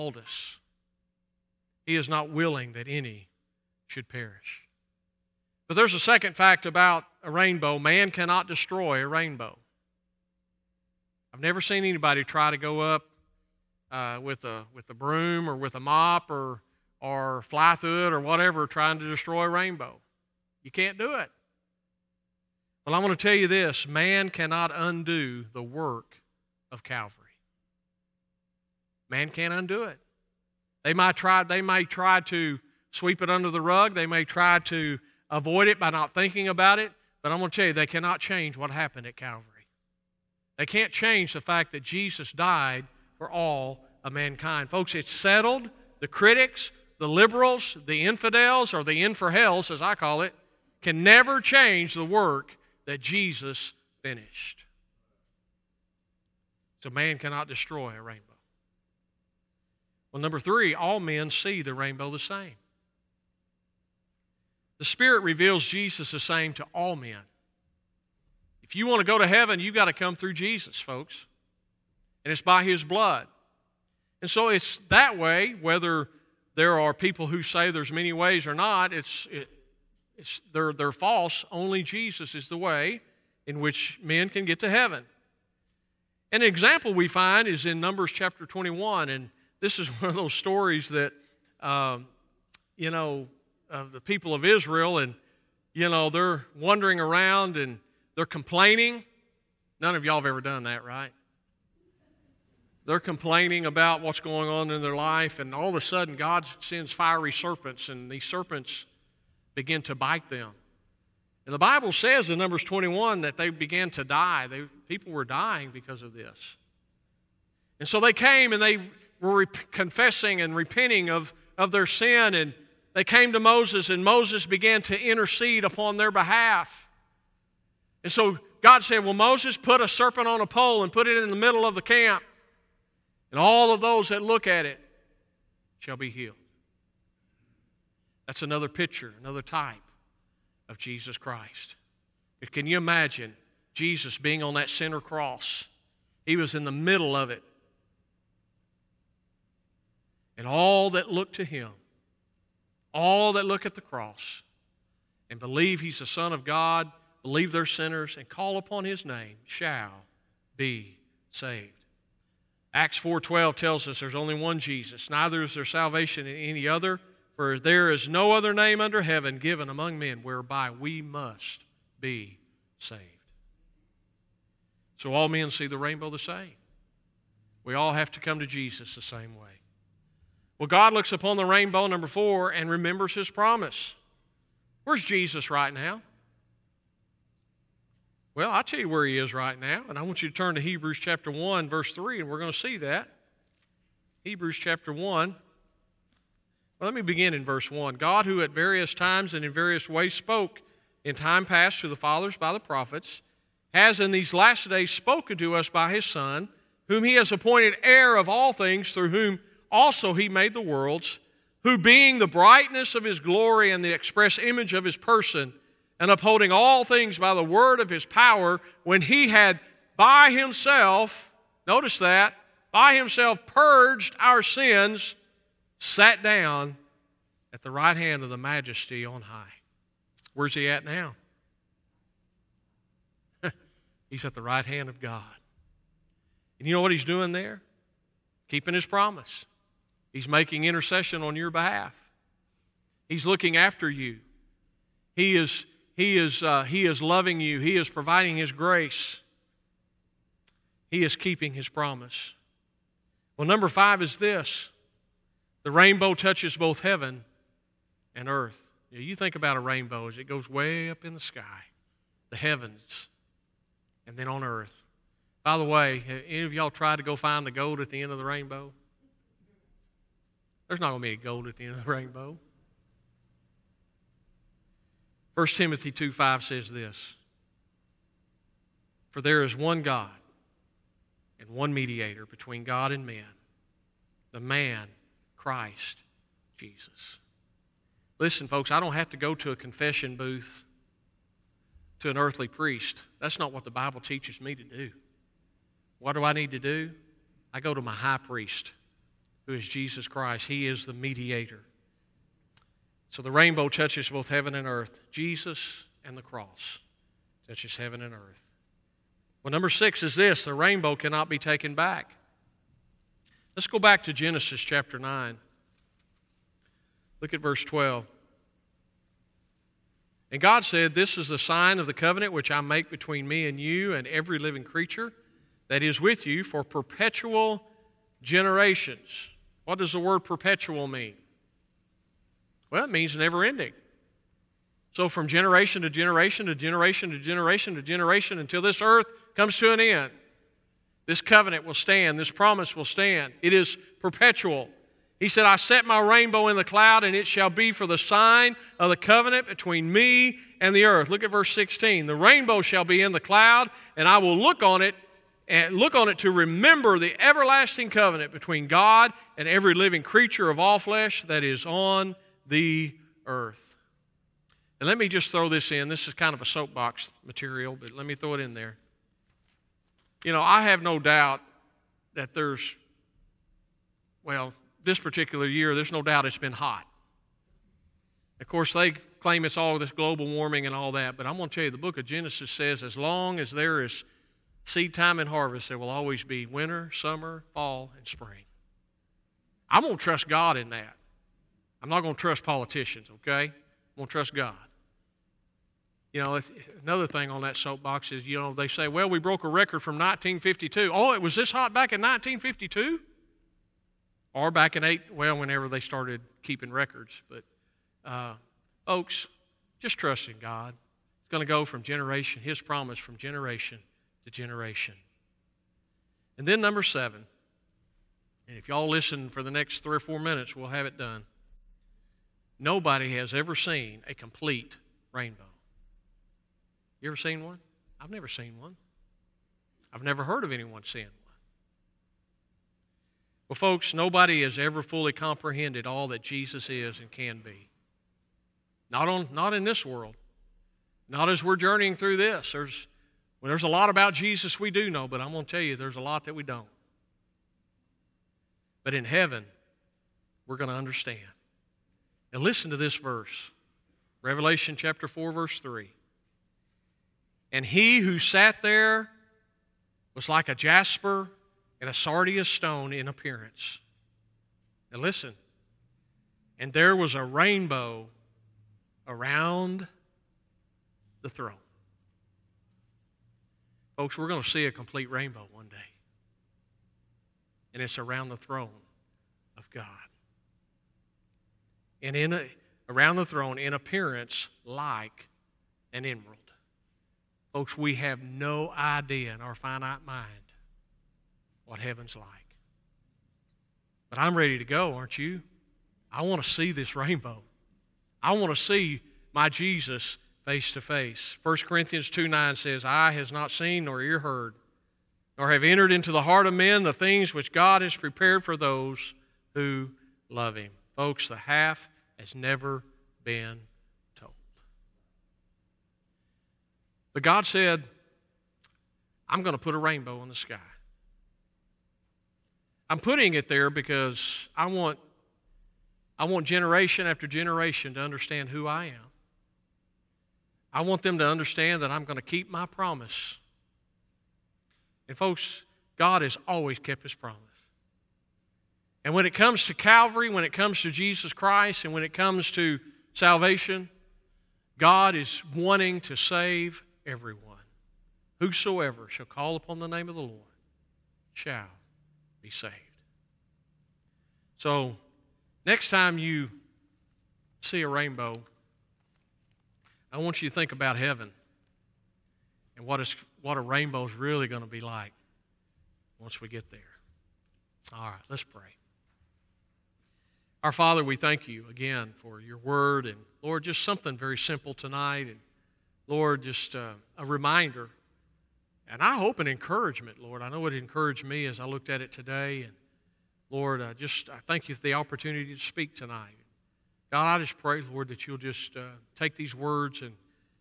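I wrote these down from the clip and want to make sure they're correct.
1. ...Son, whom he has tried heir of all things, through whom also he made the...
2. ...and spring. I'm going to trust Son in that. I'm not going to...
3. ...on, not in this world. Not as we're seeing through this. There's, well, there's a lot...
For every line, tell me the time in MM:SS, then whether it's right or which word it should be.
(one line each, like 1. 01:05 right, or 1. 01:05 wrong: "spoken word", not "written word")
1. 03:26 wrong: "appointed", not "tried"
2. 06:27 wrong: "God", not "Son"
3. 07:19 wrong: "journeying", not "seeing".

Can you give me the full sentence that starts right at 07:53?
Folks, we're going to see a complete rainbow one day.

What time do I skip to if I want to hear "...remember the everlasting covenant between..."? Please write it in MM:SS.
05:56.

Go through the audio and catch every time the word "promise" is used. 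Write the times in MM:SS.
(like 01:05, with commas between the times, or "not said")
03:03, 03:58, 04:11, 05:42, 06:52, 08:52, 08:57.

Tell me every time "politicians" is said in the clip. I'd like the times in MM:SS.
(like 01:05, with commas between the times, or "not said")
06:32.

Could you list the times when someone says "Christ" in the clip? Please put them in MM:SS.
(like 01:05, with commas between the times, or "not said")
02:21, 04:45, 05:00, 09:01.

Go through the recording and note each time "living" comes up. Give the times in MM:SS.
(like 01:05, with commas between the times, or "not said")
05:24, 05:59.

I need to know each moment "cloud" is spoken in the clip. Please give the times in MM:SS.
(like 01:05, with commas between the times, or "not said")
05:46, 05:53.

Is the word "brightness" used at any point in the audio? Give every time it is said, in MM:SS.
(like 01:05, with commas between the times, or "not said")
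03:32.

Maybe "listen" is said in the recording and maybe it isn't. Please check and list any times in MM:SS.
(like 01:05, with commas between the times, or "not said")
04:48, 06:58, 07:32, 07:45.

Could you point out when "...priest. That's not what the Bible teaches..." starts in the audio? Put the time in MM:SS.
04:52.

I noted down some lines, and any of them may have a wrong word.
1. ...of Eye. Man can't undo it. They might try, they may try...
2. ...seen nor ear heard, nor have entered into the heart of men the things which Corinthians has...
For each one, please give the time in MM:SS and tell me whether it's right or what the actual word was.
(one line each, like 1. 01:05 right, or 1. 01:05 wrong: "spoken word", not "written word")
1. 00:26 wrong: "Calvary", not "Eye"
2. 08:23 wrong: "God", not "Corinthians".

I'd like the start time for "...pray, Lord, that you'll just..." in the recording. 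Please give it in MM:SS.
09:47.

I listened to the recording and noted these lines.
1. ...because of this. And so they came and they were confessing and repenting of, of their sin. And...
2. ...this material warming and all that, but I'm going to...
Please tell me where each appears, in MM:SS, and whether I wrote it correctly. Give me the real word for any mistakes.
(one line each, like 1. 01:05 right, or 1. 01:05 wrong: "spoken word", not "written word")
1. 01:55 right
2. 06:19 wrong: "global", not "material".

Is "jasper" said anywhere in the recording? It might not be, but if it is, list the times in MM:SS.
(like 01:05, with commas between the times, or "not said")
07:40.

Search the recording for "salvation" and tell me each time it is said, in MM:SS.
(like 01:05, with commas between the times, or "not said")
02:45, 09:03.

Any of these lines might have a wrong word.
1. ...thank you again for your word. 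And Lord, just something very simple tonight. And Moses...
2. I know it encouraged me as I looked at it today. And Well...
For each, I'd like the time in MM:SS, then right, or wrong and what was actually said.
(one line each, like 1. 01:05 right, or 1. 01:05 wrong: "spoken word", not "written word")
1. 09:31 wrong: "Lord", not "Moses"
2. 09:40 wrong: "Lord", not "Well".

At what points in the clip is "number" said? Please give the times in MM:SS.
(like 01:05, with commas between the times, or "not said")
01:00, 01:27, 01:52, 03:01, 04:13, 05:09, 06:56.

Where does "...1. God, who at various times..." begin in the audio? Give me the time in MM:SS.
03:17.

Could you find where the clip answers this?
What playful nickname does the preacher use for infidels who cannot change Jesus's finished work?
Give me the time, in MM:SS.
00:49.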